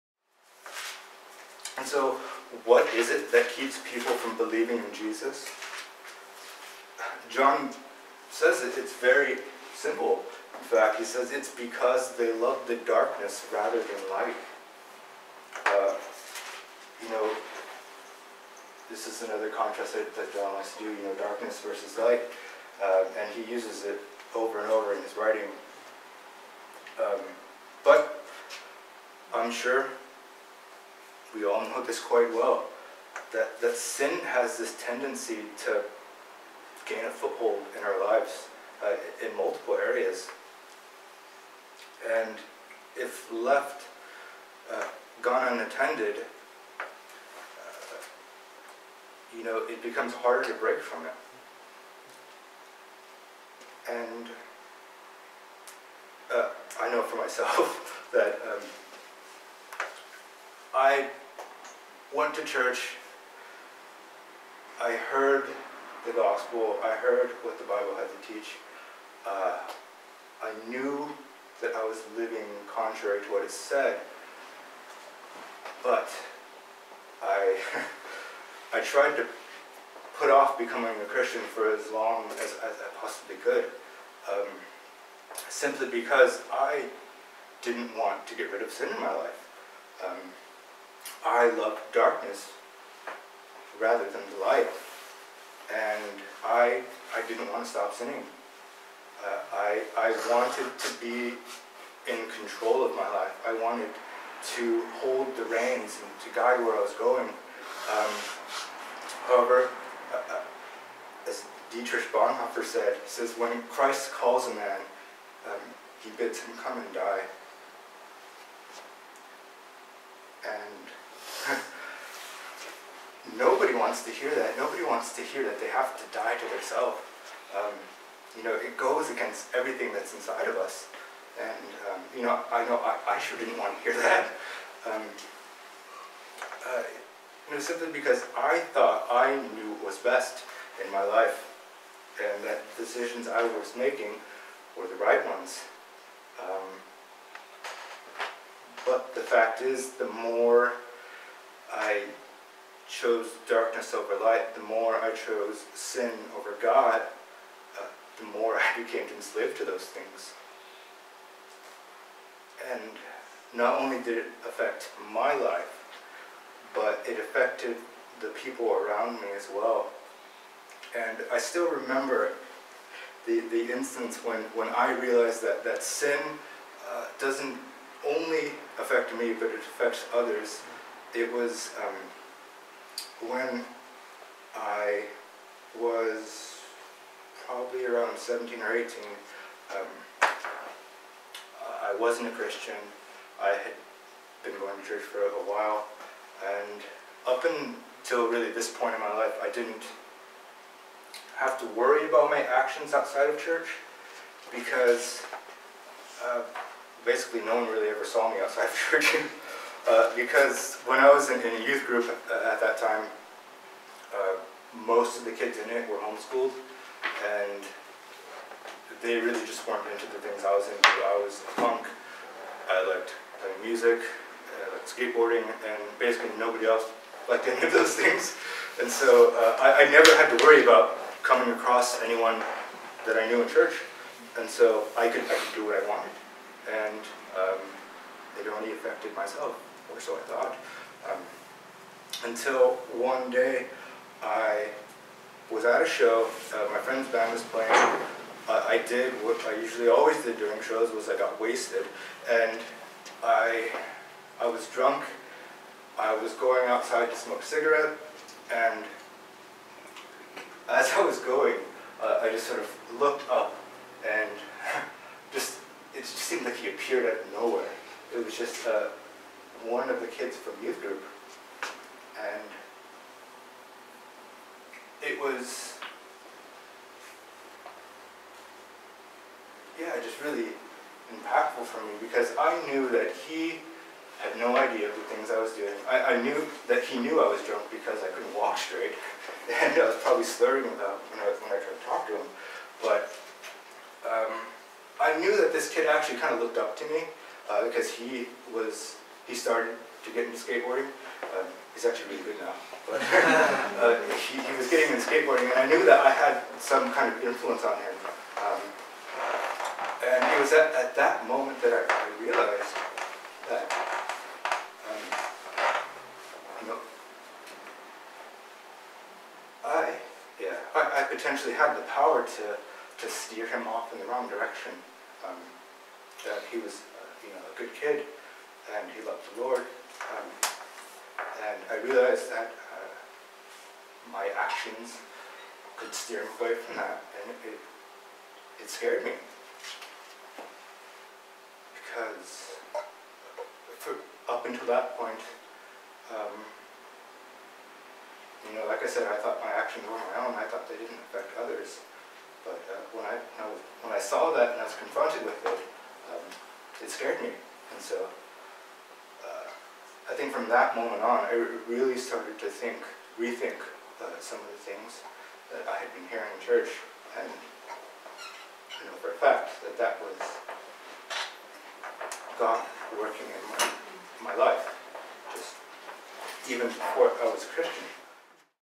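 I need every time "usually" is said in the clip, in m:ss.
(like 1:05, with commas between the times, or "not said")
4:09.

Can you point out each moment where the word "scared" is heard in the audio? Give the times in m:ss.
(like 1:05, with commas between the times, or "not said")
5:38, 5:56.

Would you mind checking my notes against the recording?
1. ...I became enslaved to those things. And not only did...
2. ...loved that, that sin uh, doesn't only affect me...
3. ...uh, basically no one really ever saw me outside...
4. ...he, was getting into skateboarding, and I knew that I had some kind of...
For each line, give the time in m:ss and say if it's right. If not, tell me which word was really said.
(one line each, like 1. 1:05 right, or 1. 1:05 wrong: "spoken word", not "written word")
1. 2:38 right
2. 2:54 wrong: "realized", not "loved"
3. 3:26 right
4. 5:04 right.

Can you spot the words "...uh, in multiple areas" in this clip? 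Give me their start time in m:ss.
0:38.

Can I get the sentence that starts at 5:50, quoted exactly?
I thought they didn't affect others.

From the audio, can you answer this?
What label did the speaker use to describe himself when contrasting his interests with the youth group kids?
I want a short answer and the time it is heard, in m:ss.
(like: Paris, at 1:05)
a punk, at 3:41.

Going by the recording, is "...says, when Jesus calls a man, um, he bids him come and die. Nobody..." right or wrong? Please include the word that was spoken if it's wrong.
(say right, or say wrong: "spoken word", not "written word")
wrong: "Christ", not "Jesus".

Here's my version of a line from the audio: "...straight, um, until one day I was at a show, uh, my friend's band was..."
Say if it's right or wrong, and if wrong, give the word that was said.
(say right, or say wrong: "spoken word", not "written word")
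wrong: "thought", not "straight".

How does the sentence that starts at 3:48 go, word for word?
And so uh, I, I, never had to worry about coming across anyone that I knew in church.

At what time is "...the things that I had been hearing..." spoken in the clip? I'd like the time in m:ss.
6:04.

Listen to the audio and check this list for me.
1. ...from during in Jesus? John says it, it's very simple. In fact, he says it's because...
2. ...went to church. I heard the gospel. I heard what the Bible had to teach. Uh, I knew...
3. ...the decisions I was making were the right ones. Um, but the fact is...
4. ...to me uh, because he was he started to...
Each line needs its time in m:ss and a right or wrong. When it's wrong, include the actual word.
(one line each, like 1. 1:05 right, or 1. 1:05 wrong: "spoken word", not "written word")
1. 0:04 wrong: "believing", not "during"
2. 1:02 right
3. 2:22 right
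4. 4:56 right.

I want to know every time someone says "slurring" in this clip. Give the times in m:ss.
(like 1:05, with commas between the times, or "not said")
4:50.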